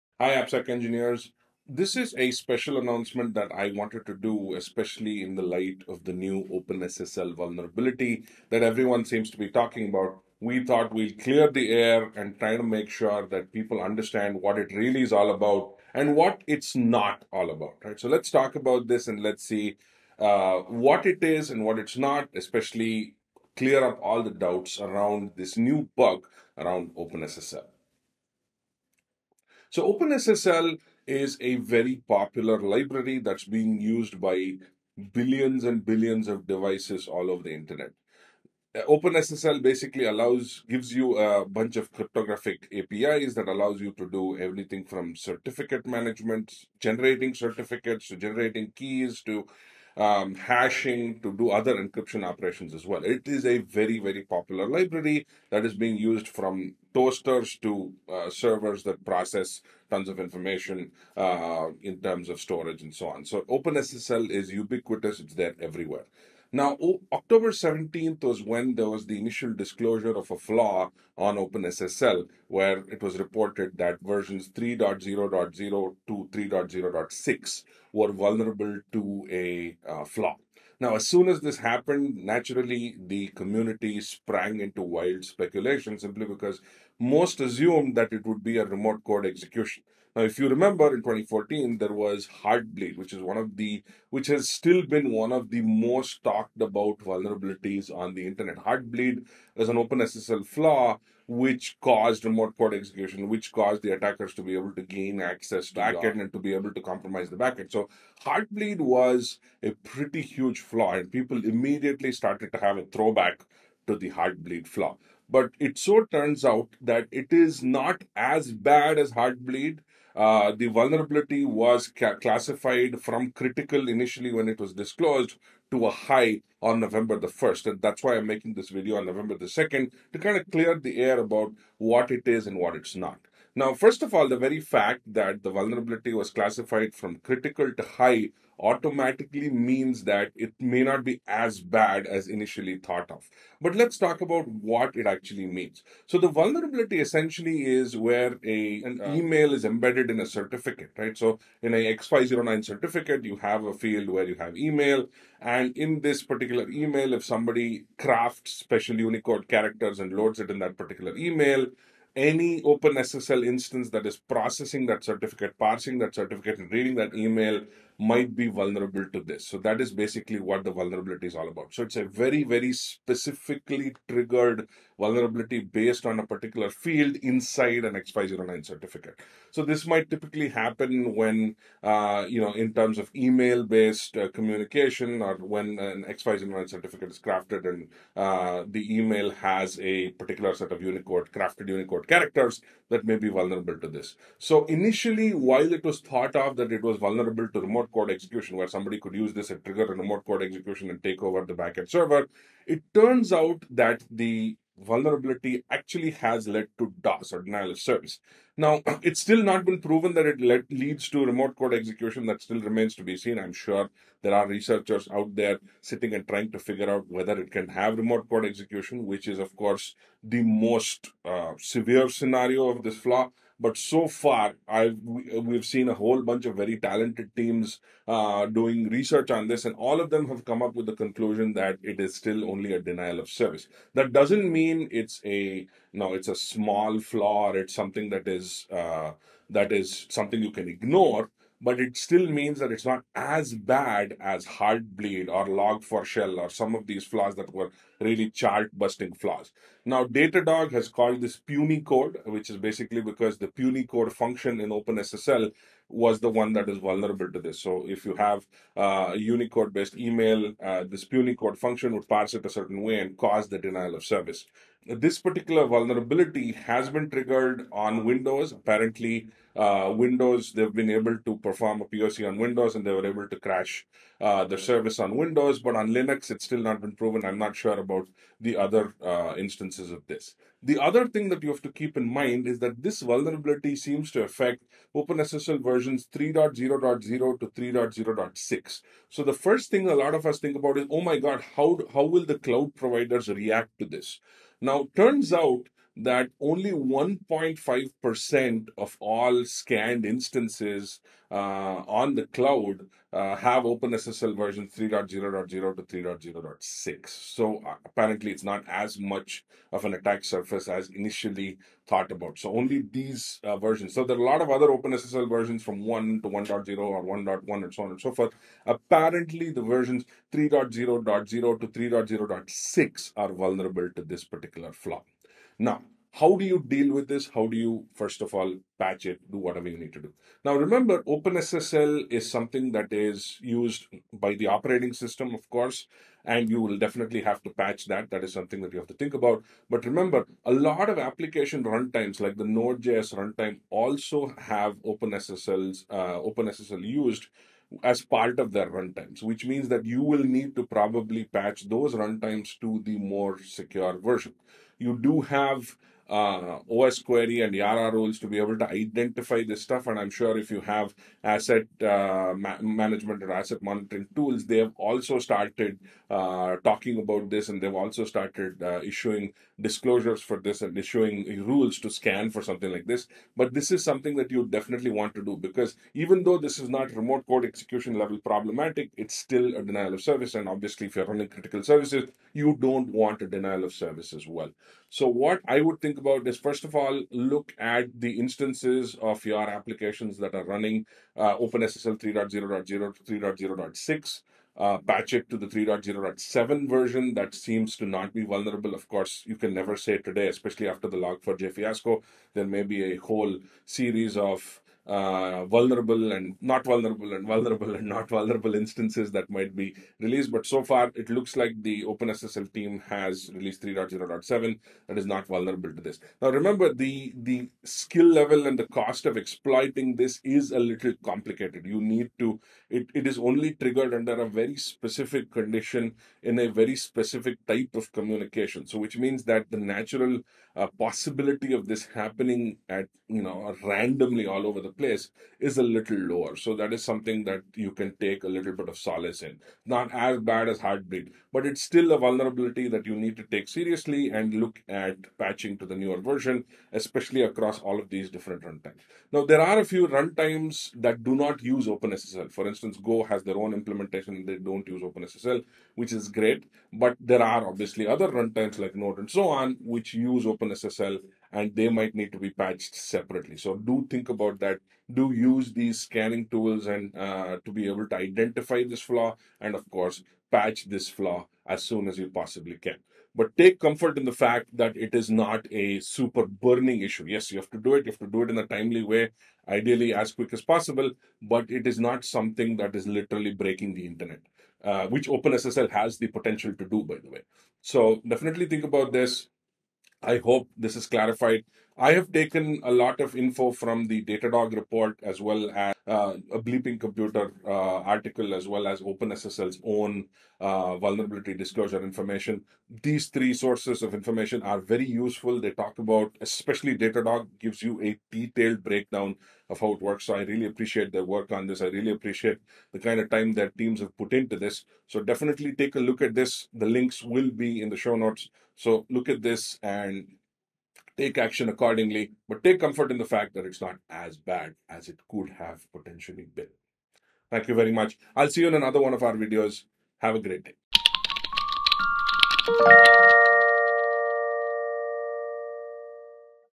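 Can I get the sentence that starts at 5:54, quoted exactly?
You do have uh, osquery and YARA rules to be able to identify this stuff.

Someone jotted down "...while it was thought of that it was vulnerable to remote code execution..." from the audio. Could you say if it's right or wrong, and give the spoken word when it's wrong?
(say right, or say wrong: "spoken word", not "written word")
right.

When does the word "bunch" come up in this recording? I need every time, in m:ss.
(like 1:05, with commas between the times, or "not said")
0:41, 3:46.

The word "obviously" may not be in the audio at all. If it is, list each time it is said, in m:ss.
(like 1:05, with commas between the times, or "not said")
6:20, 7:37.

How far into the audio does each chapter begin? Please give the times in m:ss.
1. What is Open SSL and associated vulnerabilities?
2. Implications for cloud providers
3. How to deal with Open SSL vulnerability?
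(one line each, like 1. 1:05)
1. 0:29
2. 4:50
3. 5:26.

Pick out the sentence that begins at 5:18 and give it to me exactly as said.
Apparently, the versions 3.0.0 to 3.0.6 are vulnerable to this particular flaw.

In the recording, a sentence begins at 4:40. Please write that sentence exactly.
The other thing that you have to keep in mind is that this vulnerability seems to affect OpenSSL versions 3.0.0 to 3.0.6.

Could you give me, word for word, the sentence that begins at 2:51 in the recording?
So it's a very, very specifically triggered vulnerability based on a particular field inside an x 9 certificate.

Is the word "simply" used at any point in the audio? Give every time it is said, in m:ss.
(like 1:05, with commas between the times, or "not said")
1:25.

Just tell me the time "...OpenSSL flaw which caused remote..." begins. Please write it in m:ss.
1:39.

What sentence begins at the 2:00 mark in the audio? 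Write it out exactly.
Uh, the vulnerability was ca- classified from critical initially when it was disclosed to a high on November the 1st.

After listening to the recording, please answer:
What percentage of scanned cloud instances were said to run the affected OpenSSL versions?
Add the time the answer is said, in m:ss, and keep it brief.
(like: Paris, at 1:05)
1.5%, at 4:56.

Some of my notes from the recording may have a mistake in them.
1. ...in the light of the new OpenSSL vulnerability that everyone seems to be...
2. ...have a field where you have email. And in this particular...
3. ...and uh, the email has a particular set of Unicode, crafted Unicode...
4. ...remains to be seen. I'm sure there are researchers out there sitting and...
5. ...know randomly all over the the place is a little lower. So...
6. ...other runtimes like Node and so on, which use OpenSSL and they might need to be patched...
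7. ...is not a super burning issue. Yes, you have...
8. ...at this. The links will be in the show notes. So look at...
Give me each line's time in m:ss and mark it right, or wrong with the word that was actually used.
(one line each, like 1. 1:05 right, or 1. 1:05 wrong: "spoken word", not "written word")
1. 0:05 right
2. 2:33 right
3. 3:07 right
4. 3:32 right
5. 7:13 right
6. 7:37 right
7. 7:54 right
8. 8:36 right.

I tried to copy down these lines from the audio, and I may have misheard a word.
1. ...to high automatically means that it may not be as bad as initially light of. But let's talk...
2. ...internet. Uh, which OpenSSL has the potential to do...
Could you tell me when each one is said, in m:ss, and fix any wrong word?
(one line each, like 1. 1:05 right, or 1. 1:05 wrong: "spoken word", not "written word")
1. 2:17 wrong: "thought", not "light"
2. 8:03 right.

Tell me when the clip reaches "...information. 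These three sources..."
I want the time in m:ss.
8:21.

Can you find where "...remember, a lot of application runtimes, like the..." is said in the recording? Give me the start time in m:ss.
5:39.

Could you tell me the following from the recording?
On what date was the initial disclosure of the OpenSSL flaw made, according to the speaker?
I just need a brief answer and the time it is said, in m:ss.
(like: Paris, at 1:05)
October 17th, at 1:07.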